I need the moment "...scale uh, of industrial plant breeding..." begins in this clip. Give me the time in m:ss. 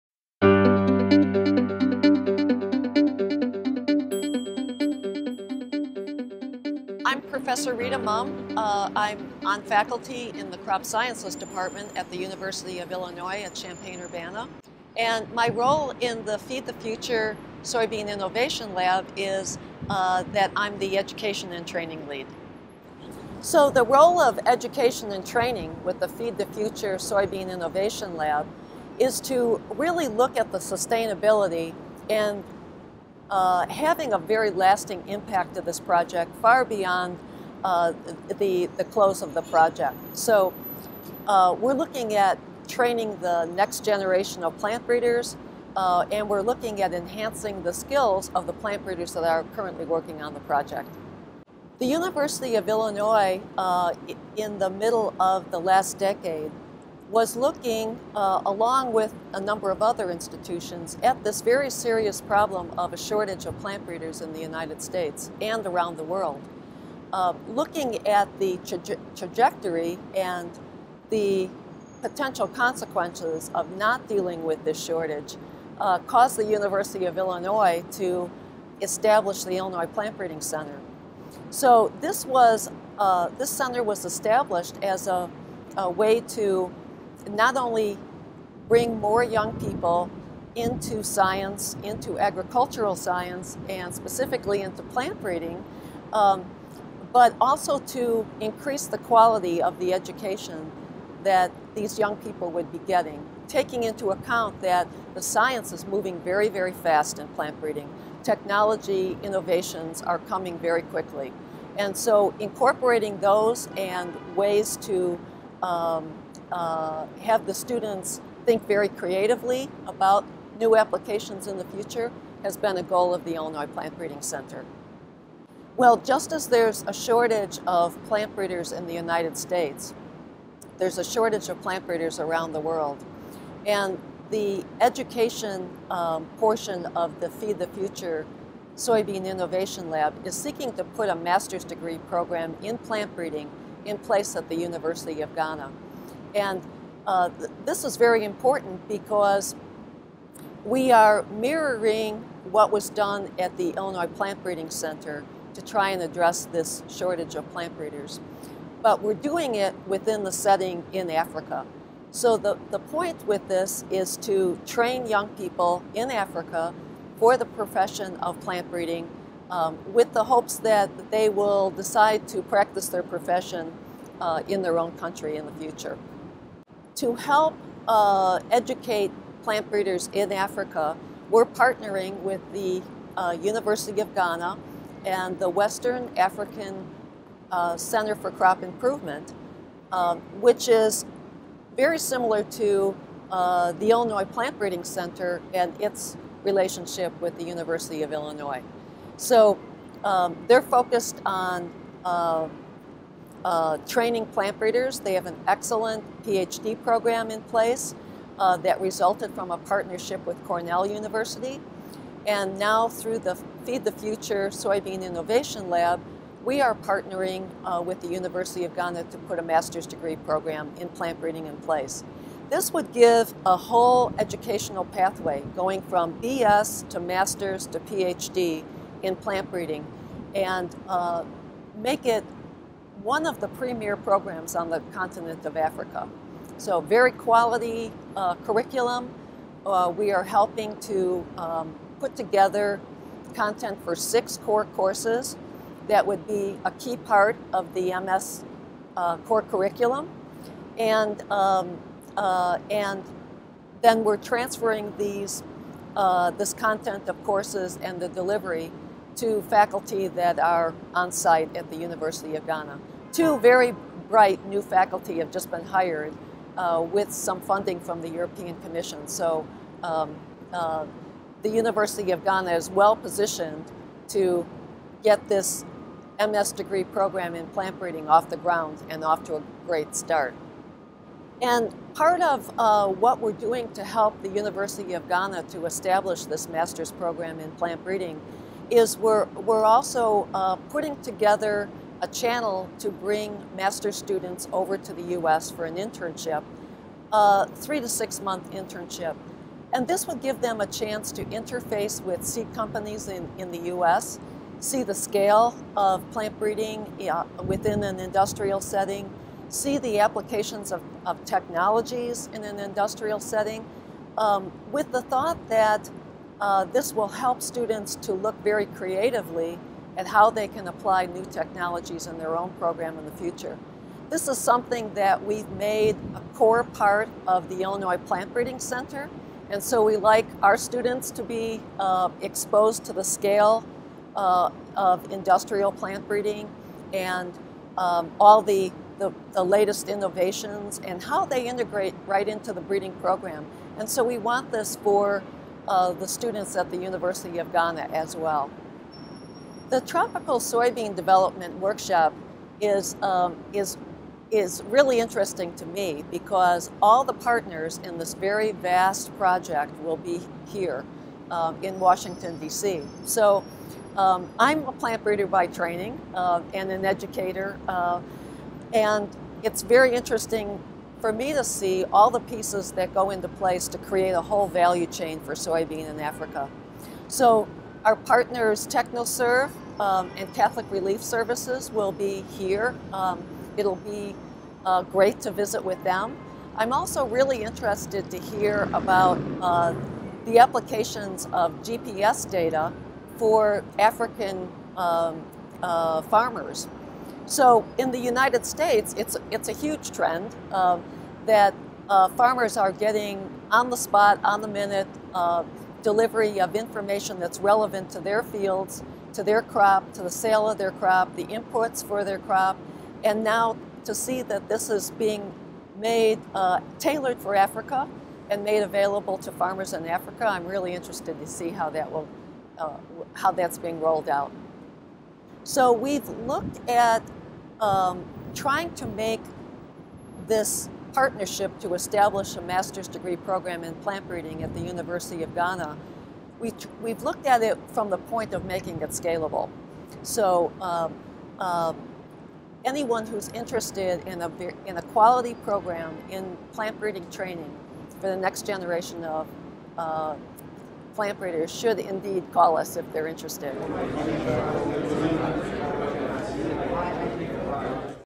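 5:33.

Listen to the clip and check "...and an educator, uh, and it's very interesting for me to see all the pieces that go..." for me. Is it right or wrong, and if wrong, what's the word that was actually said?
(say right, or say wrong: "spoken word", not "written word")
right.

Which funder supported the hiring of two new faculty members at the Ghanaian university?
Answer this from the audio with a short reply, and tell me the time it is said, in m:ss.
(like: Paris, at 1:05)
European Commission, at 4:28.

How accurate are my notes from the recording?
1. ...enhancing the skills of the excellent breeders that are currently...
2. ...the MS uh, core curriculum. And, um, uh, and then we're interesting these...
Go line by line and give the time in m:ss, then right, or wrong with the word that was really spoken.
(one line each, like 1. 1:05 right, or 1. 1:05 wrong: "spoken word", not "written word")
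1. 0:46 wrong: "plant", not "excellent"
2. 4:07 wrong: "transferring", not "interesting".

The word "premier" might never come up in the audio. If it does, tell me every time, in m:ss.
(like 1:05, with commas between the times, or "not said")
3:53.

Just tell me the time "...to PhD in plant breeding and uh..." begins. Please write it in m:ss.
3:47.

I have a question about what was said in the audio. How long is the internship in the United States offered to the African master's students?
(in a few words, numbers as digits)
3 to 6 months.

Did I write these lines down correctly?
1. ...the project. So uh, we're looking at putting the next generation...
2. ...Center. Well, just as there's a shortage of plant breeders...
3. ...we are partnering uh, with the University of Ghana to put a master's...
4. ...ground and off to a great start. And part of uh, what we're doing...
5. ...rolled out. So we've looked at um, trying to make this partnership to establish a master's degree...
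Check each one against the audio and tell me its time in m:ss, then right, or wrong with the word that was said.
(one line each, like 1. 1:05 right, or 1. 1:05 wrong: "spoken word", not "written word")
1. 0:39 wrong: "training", not "putting"
2. 2:04 right
3. 3:36 right
4. 4:38 right
5. 7:03 right.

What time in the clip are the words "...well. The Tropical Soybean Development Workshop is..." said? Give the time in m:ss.
5:48.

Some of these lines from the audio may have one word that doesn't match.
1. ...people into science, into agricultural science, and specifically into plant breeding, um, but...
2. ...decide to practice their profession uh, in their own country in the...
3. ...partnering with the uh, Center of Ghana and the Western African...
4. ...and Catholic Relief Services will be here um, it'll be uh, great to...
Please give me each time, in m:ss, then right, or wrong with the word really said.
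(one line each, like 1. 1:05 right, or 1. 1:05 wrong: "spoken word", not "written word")
1. 1:29 right
2. 2:51 right
3. 3:01 wrong: "University", not "Center"
4. 6:20 right.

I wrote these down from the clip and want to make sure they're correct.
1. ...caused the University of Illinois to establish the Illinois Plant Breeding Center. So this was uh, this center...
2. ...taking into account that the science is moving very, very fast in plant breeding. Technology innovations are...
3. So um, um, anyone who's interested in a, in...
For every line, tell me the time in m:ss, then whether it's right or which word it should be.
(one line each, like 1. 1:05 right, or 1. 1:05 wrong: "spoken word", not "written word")
1. 1:15 right
2. 1:43 right
3. 7:20 right.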